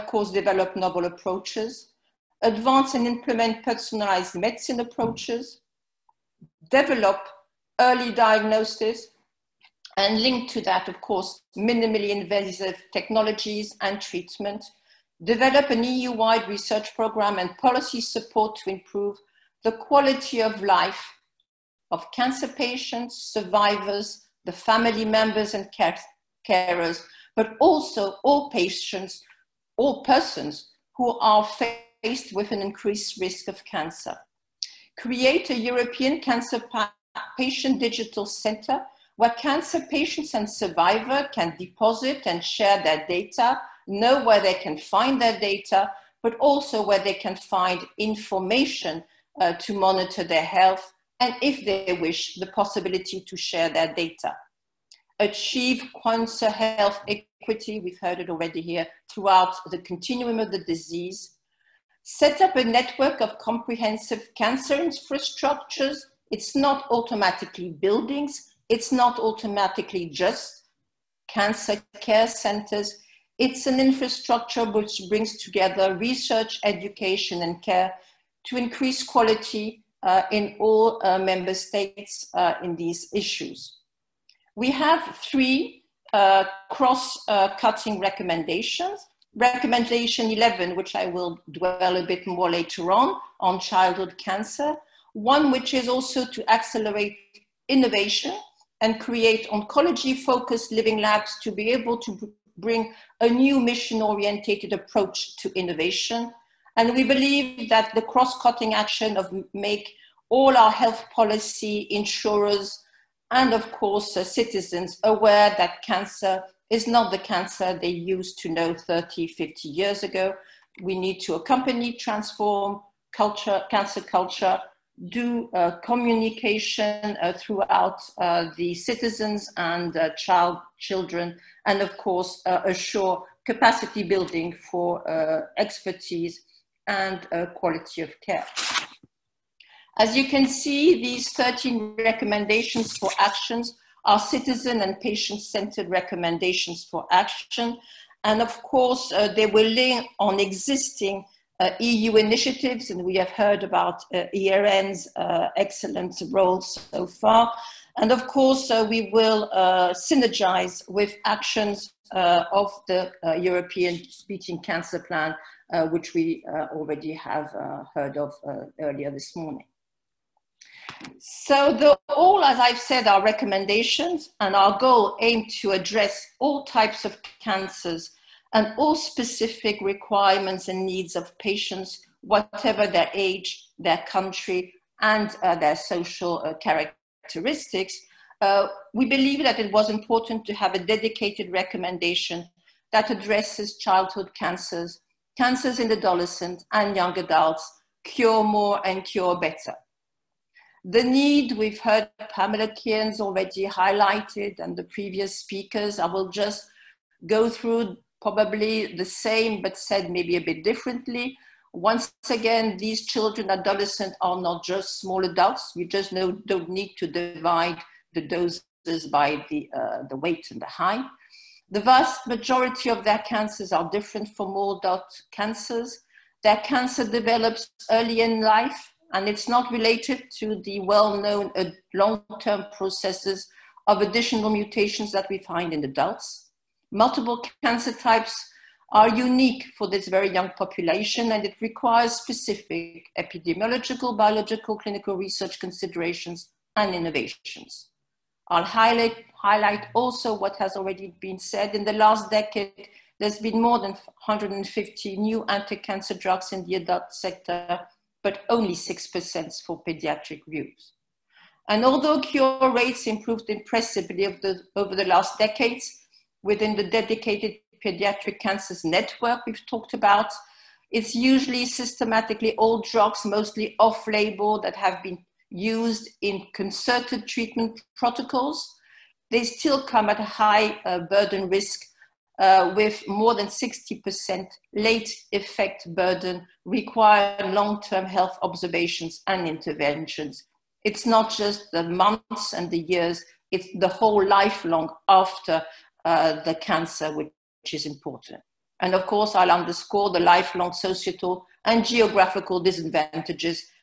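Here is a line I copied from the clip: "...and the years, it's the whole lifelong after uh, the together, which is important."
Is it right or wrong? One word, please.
wrong.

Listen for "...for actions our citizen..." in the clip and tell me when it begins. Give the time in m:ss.
2:22.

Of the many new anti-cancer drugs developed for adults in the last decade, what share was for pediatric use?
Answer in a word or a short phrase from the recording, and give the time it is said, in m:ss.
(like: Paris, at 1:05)
6%, at 4:18.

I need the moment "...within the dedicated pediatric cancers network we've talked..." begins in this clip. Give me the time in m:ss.
4:26.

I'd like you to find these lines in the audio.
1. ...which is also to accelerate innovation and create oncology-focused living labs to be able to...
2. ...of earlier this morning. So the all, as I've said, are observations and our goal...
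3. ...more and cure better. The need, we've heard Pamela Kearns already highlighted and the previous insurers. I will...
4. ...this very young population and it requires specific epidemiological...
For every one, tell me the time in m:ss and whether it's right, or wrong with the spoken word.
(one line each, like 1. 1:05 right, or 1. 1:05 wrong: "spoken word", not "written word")
1. 1:35 right
2. 2:48 wrong: "recommendations", not "observations"
3. 3:18 wrong: "speakers", not "insurers"
4. 3:59 right.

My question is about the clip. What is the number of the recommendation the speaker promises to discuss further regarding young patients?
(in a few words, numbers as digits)
11.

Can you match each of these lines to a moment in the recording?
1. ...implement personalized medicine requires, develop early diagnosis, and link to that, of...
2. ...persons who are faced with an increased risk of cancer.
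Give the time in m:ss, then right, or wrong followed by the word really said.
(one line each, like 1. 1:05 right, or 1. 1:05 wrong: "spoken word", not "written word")
1. 0:03 wrong: "approaches", not "requires"
2. 0:30 right.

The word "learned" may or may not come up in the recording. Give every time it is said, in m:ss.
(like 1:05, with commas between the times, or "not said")
not said.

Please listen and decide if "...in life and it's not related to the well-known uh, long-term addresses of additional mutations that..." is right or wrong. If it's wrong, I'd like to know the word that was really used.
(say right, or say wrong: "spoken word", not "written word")
wrong: "processes", not "addresses".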